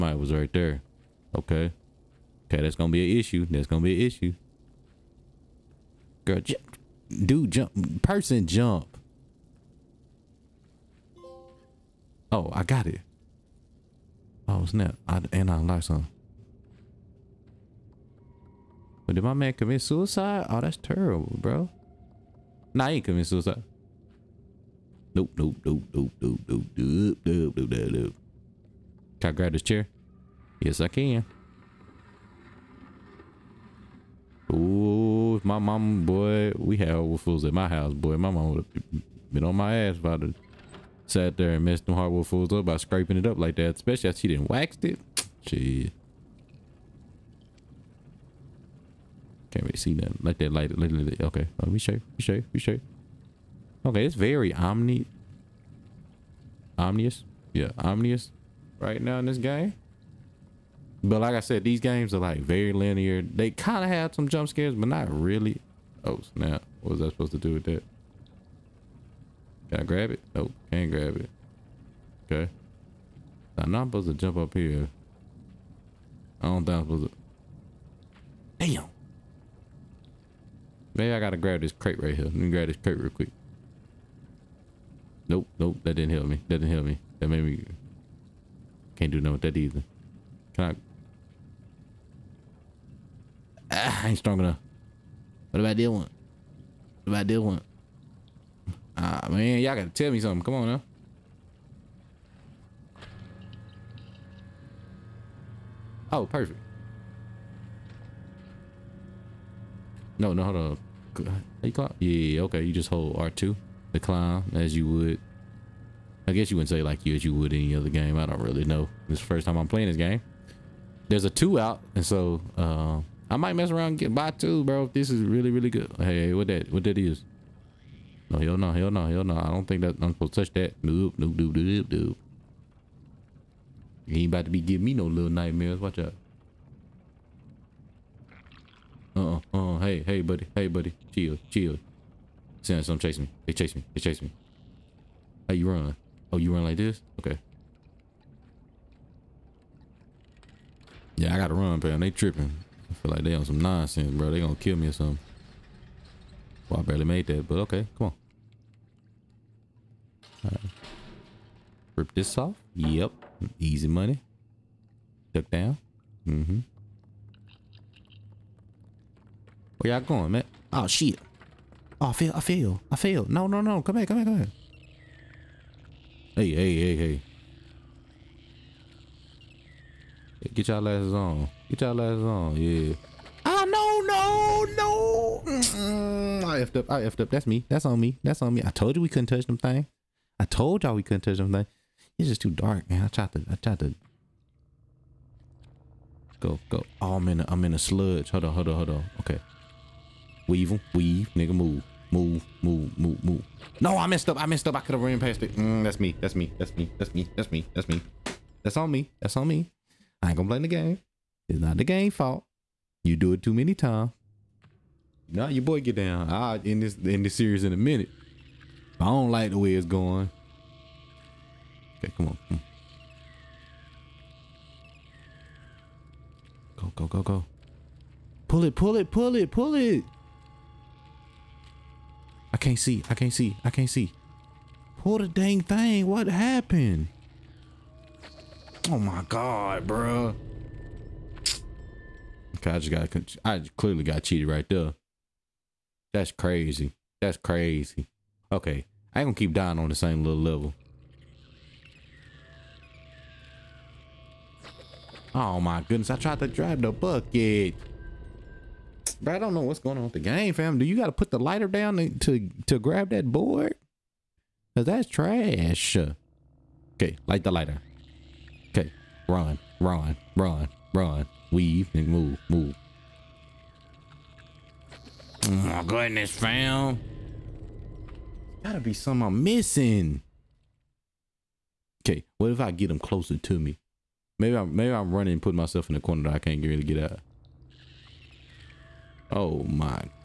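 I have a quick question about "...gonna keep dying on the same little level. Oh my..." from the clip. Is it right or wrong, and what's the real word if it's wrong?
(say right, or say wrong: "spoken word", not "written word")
right.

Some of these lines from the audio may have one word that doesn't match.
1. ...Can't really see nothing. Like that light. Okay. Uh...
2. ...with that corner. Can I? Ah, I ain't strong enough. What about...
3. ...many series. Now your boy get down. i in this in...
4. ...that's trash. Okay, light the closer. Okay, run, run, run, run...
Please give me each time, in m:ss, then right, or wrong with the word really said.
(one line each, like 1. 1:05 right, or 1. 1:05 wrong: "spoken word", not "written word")
1. 0:49 right
2. 1:29 wrong: "either", not "corner"
3. 3:33 wrong: "times", not "series"
4. 4:24 wrong: "lighter", not "closer".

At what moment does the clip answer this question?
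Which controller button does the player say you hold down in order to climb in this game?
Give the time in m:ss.
1:53.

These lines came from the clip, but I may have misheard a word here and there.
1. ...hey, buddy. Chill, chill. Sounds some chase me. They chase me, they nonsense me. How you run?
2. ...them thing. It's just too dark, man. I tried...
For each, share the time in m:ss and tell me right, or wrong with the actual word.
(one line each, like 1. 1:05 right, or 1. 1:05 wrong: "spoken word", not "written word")
1. 2:20 wrong: "chase", not "nonsense"
2. 3:11 right.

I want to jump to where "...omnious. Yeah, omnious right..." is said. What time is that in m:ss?
0:56.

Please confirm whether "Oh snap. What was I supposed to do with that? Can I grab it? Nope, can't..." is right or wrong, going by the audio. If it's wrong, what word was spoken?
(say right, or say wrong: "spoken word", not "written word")
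right.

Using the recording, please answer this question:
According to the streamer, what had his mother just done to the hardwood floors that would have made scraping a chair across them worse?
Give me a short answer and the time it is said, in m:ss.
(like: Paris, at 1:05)
waxed it, at 0:44.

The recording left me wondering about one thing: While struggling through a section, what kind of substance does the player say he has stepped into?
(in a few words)
sludge.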